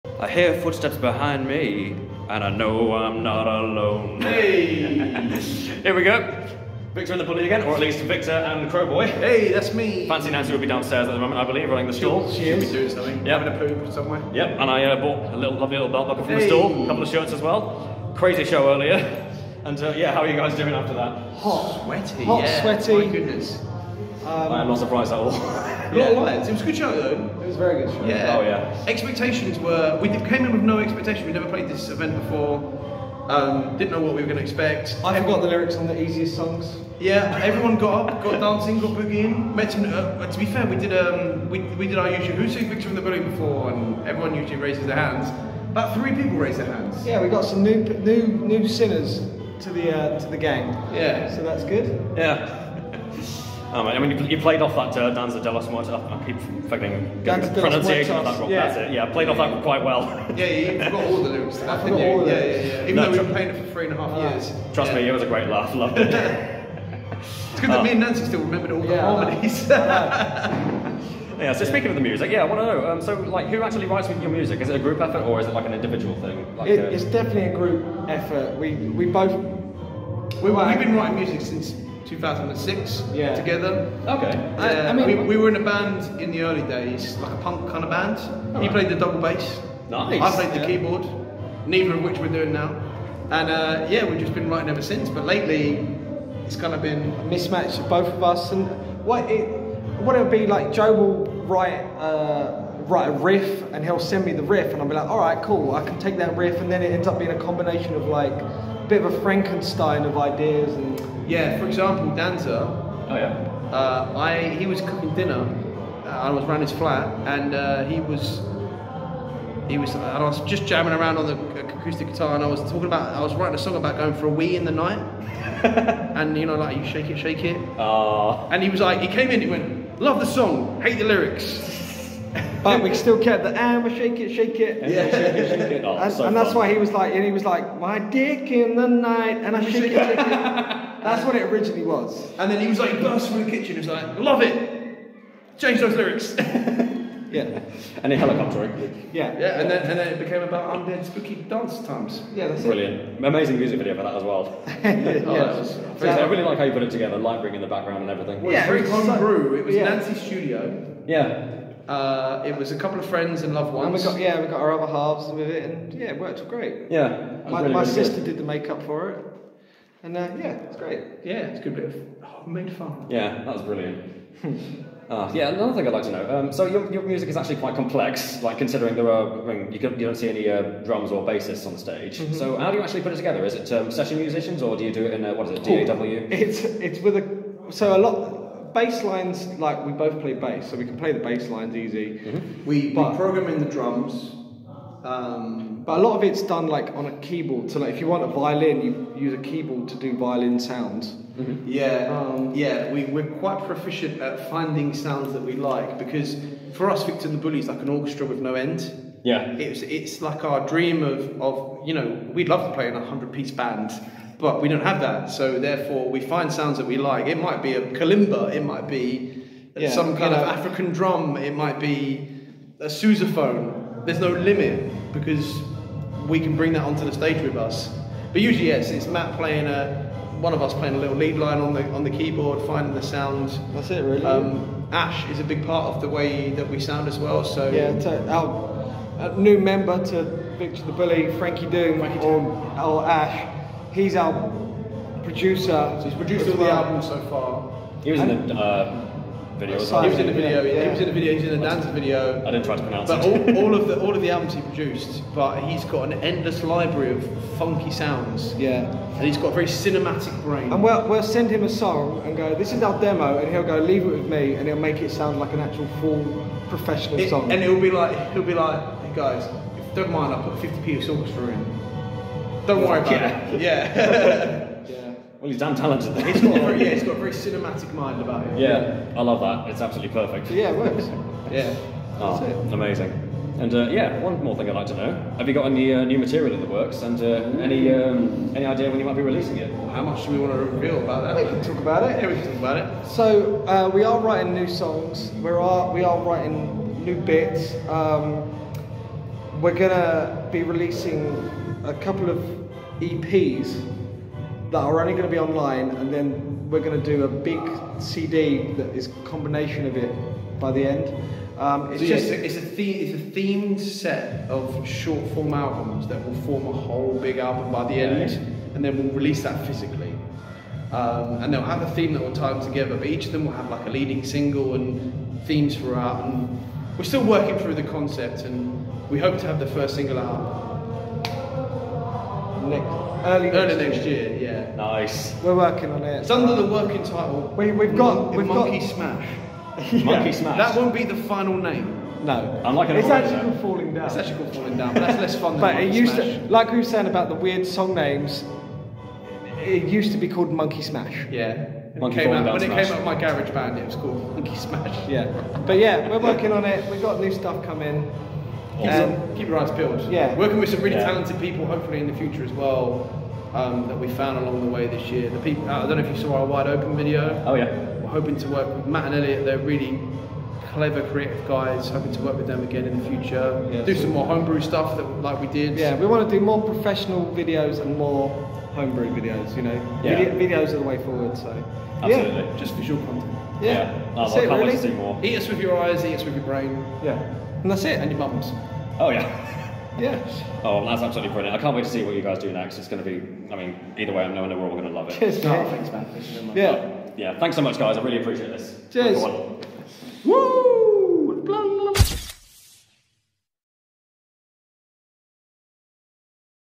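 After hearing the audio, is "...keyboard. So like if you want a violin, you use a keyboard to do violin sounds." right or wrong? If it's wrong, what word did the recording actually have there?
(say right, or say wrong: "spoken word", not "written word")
right.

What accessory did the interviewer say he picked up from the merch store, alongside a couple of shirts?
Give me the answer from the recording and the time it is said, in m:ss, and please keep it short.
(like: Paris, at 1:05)
Belt buckle, at 0:15.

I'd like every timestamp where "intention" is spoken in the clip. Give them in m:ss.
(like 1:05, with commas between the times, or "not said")
not said.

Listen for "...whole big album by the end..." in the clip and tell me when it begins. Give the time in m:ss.
5:16.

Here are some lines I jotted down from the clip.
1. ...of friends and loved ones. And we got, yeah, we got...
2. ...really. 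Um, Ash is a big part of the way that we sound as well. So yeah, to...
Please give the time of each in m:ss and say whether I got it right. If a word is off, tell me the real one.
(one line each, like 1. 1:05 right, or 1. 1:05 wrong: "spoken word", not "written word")
1. 2:42 right
2. 3:54 right.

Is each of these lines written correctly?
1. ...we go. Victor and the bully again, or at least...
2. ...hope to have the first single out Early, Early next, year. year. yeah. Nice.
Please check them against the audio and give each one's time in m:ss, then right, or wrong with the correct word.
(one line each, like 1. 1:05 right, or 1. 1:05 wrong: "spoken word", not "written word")
1. 0:05 right
2. 5:29 right.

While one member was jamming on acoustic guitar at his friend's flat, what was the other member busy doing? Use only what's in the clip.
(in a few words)
Cooking dinner.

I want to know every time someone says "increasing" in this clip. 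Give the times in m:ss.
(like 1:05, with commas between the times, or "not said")
not said.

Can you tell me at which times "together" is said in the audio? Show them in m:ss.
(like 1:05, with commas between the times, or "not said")
1:23, 2:36, 3:03, 5:22.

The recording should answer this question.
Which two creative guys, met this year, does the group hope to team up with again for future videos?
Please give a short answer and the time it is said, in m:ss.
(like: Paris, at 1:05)
Matt and Elliot, at 6:08.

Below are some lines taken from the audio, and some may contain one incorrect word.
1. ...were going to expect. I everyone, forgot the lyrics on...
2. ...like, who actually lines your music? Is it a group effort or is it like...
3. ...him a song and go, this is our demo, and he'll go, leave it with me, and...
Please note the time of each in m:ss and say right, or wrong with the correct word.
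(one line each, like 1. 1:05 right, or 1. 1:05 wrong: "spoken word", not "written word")
1. 0:34 right
2. 1:13 wrong: "writes", not "lines"
3. 4:21 right.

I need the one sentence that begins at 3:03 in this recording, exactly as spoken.
Is it um, session musicians or do you do it in, a, what is it, DAW?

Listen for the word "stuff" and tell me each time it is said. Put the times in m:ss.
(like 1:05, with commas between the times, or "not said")
5:57, 6:14.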